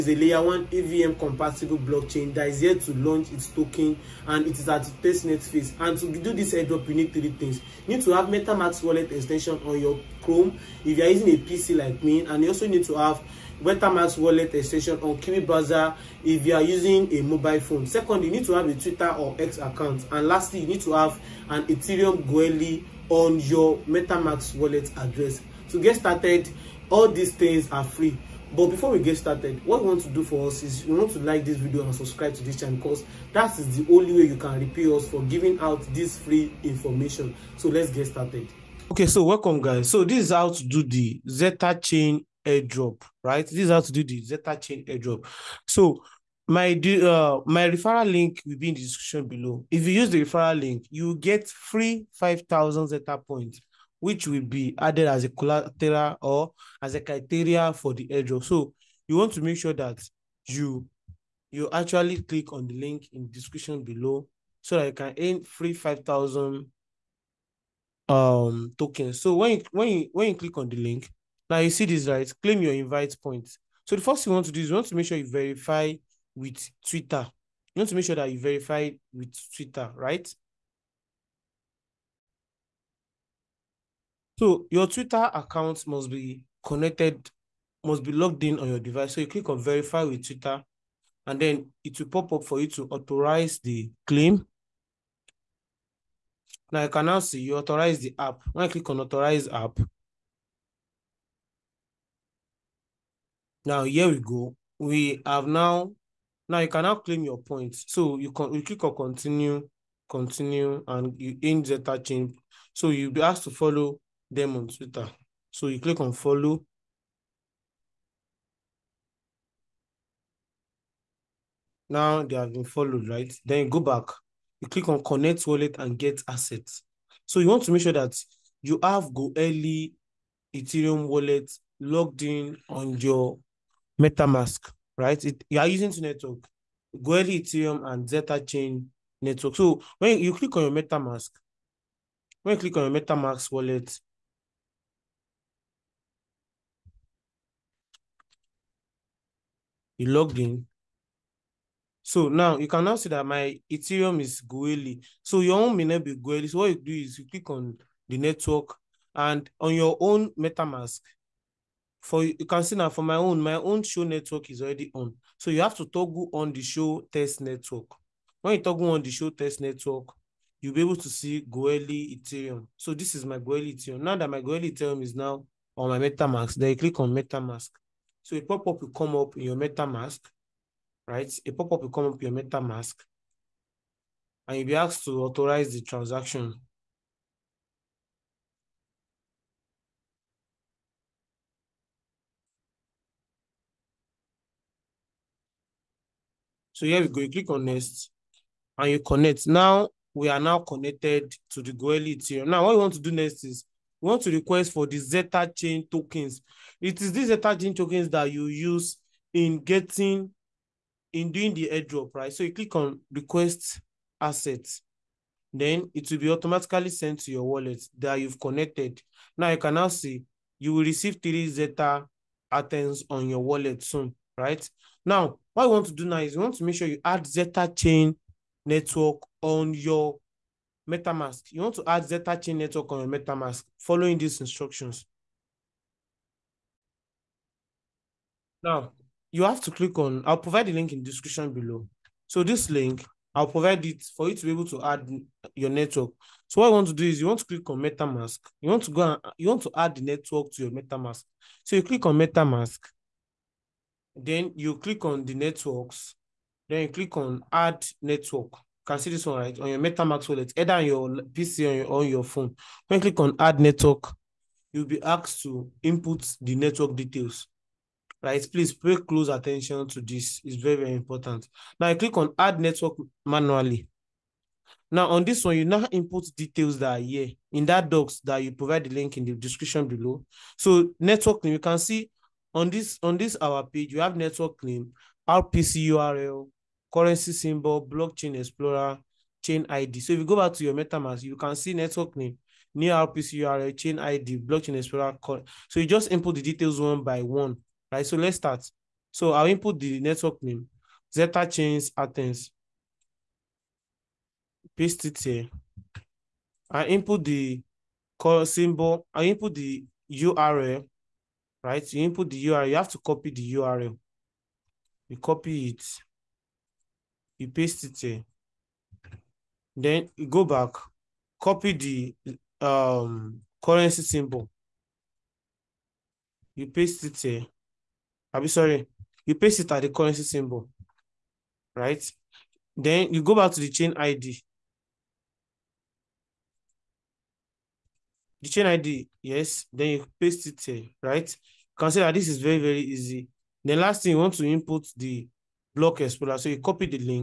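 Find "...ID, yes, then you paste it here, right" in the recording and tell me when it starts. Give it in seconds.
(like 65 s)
338 s.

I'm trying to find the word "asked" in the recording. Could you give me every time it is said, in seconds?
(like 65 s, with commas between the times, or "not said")
113 s, 184 s, 265 s.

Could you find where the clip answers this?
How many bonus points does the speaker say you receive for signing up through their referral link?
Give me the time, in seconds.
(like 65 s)
51 s.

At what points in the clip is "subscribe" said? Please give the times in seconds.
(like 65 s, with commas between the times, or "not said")
31 s.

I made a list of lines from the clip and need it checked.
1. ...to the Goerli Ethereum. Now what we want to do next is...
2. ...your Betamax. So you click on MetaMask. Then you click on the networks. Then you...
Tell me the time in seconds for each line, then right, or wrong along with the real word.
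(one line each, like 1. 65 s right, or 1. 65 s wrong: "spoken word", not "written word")
1. 201 s right
2. 250 s wrong: "MetaMask", not "Betamax".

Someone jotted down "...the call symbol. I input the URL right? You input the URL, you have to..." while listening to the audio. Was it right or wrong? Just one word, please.
right.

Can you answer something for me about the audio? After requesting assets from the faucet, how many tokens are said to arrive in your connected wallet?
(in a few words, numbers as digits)
3 Zeta.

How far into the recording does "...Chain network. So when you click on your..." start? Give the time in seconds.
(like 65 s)
138 s.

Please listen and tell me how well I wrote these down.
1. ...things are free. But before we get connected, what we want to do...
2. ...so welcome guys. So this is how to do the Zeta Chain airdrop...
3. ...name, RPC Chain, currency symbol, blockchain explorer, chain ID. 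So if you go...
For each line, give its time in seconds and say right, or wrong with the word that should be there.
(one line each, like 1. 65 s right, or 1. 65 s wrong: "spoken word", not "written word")
1. 27 s wrong: "started", not "connected"
2. 39 s right
3. 284 s wrong: "URL", not "Chain".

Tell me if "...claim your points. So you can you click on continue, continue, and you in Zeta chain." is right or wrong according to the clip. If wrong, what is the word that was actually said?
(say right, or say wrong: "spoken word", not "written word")
right.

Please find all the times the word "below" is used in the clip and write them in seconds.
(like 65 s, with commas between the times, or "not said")
49 s, 63 s, 241 s, 279 s.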